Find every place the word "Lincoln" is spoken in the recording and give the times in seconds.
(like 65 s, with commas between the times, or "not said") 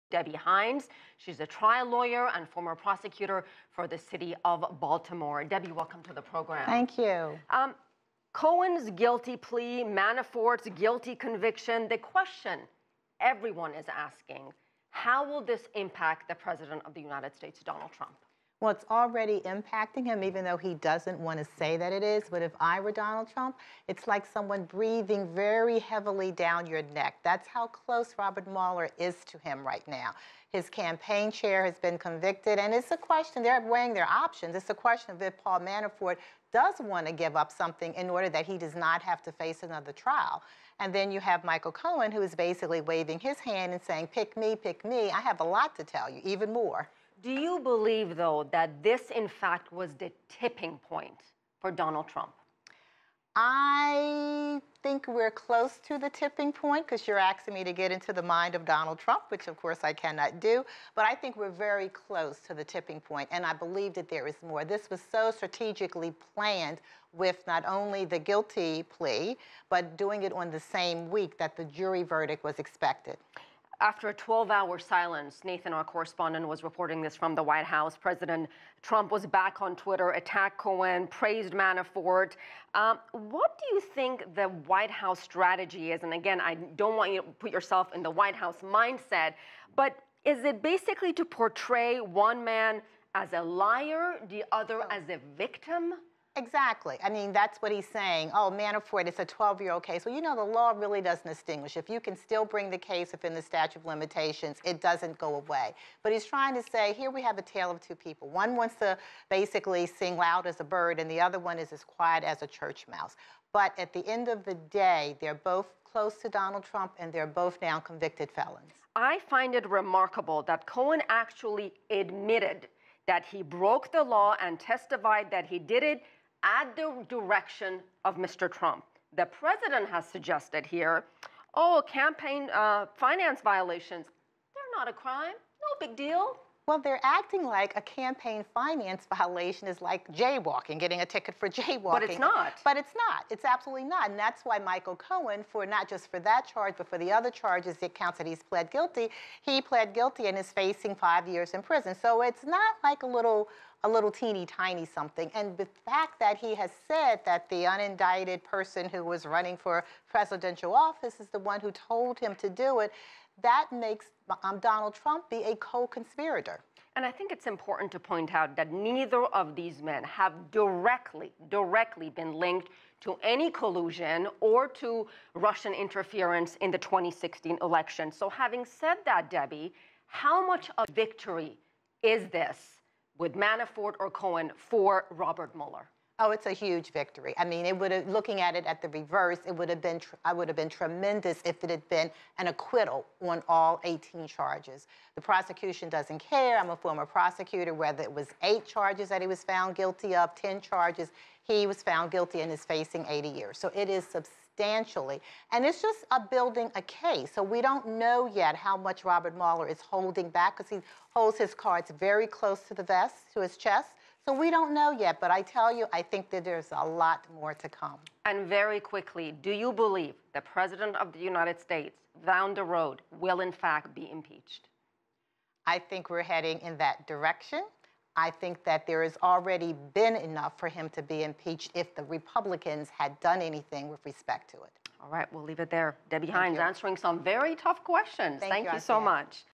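not said.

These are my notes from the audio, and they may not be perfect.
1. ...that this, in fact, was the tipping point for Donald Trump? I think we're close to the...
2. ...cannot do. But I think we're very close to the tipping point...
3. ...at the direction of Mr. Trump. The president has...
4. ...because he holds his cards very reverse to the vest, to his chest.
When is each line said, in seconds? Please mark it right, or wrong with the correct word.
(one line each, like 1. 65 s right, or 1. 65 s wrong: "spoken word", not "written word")
1. 48 s right
2. 59 s right
3. 126 s right
4. 210 s wrong: "close", not "reverse".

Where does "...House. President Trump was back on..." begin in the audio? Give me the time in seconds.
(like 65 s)
77 s.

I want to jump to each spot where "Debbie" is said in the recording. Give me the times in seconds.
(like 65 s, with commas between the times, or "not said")
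0 s, 5 s, 179 s, 236 s.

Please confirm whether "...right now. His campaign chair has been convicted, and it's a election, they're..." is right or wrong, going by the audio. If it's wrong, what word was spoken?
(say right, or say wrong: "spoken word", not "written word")
wrong: "question", not "election".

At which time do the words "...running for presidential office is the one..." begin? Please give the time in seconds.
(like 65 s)
159 s.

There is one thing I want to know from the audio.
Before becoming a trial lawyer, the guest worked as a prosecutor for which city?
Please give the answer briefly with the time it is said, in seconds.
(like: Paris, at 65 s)
Baltimore, at 4 s.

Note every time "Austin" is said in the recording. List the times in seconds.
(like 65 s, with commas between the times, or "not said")
not said.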